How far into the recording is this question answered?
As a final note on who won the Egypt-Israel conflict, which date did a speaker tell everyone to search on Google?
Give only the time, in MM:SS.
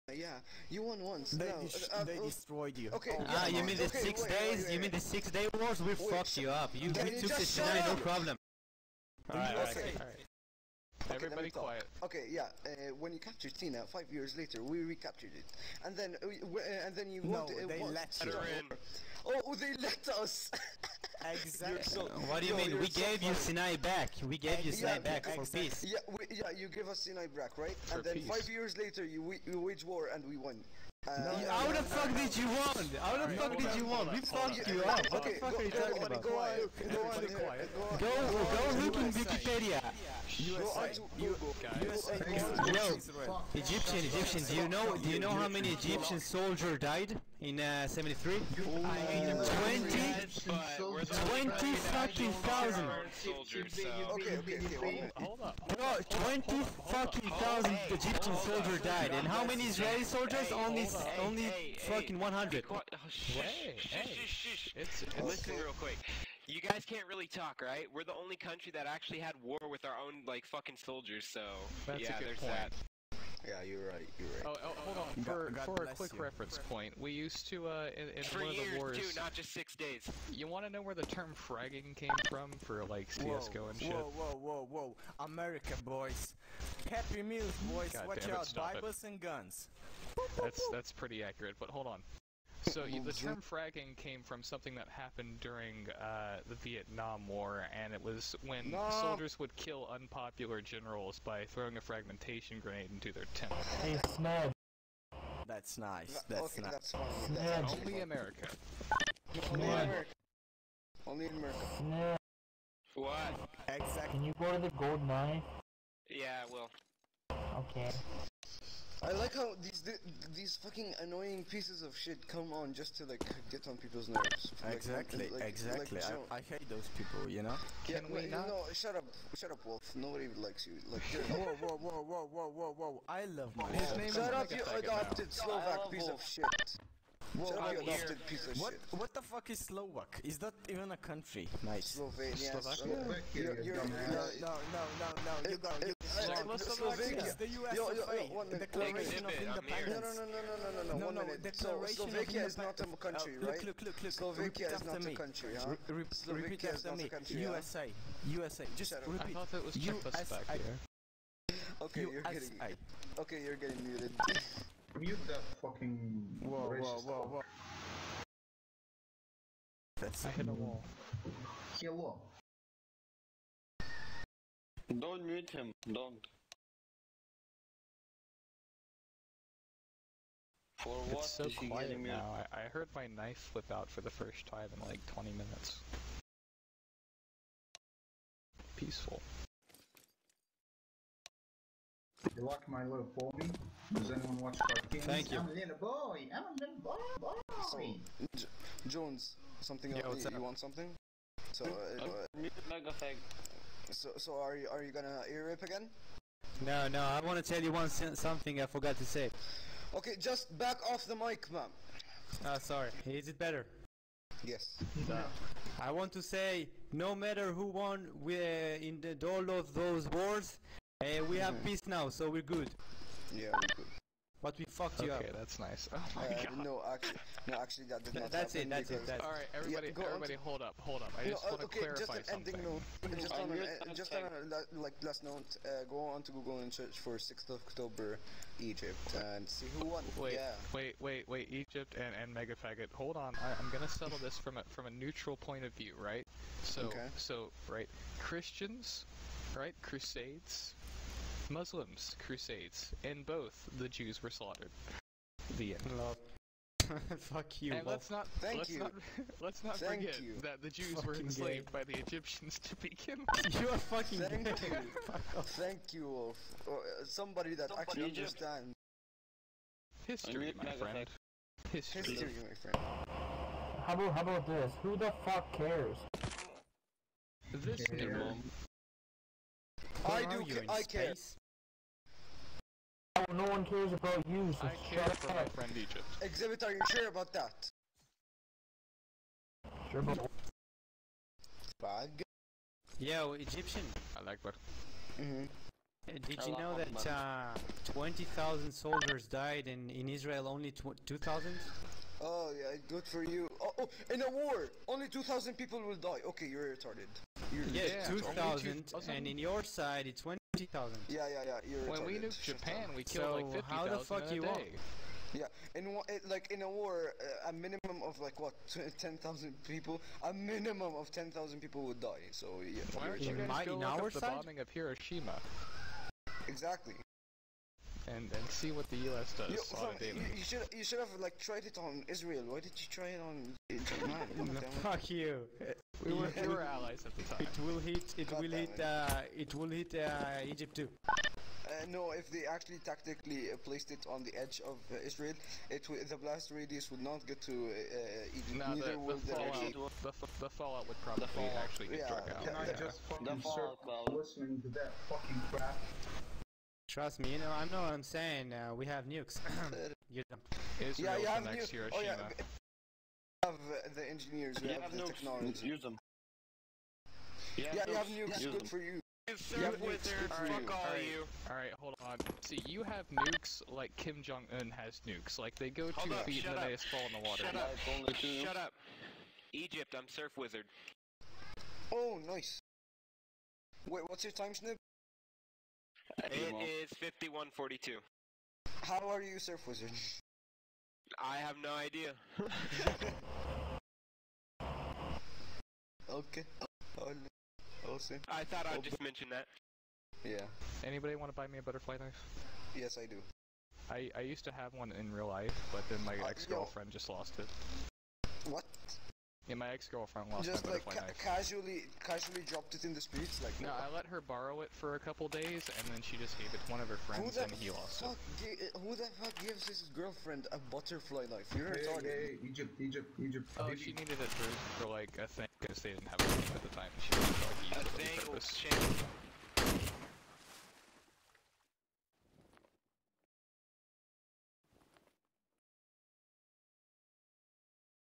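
03:57.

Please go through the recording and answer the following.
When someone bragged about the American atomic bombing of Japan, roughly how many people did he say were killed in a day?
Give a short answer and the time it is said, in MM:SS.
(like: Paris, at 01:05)
50,000, at 05:13.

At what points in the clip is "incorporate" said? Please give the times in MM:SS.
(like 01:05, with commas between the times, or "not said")
not said.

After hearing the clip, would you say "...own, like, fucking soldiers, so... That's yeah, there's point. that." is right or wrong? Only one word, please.
right.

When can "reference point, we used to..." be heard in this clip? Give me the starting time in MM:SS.
01:16.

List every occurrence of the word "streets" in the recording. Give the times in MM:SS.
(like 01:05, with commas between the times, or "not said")
06:53.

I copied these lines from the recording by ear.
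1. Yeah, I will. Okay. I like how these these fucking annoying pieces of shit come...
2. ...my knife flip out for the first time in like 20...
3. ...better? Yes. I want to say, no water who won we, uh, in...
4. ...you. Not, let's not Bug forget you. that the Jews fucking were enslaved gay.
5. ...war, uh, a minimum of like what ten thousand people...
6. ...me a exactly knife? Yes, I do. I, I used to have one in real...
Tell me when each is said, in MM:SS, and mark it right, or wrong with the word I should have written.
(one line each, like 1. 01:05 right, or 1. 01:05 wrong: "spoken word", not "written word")
1. 01:56 right
2. 03:02 right
3. 03:33 wrong: "matter", not "water"
4. 04:18 wrong: "Thank", not "Bug"
5. 05:16 right
6. 06:41 wrong: "butterfly", not "exactly".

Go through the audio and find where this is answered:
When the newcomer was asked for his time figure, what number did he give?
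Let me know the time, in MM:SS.
06:26.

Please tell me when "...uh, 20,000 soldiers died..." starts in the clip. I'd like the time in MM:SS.
04:57.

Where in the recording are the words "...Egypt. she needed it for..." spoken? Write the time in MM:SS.
07:03.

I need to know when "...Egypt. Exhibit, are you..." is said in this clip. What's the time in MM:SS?
04:45.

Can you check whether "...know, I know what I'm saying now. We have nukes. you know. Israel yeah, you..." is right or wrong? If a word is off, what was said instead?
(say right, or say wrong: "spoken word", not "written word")
right.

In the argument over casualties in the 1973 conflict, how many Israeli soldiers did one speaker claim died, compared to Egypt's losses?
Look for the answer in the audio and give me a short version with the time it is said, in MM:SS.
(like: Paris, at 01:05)
100, at 01:02.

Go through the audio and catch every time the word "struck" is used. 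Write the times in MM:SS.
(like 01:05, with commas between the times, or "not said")
05:52.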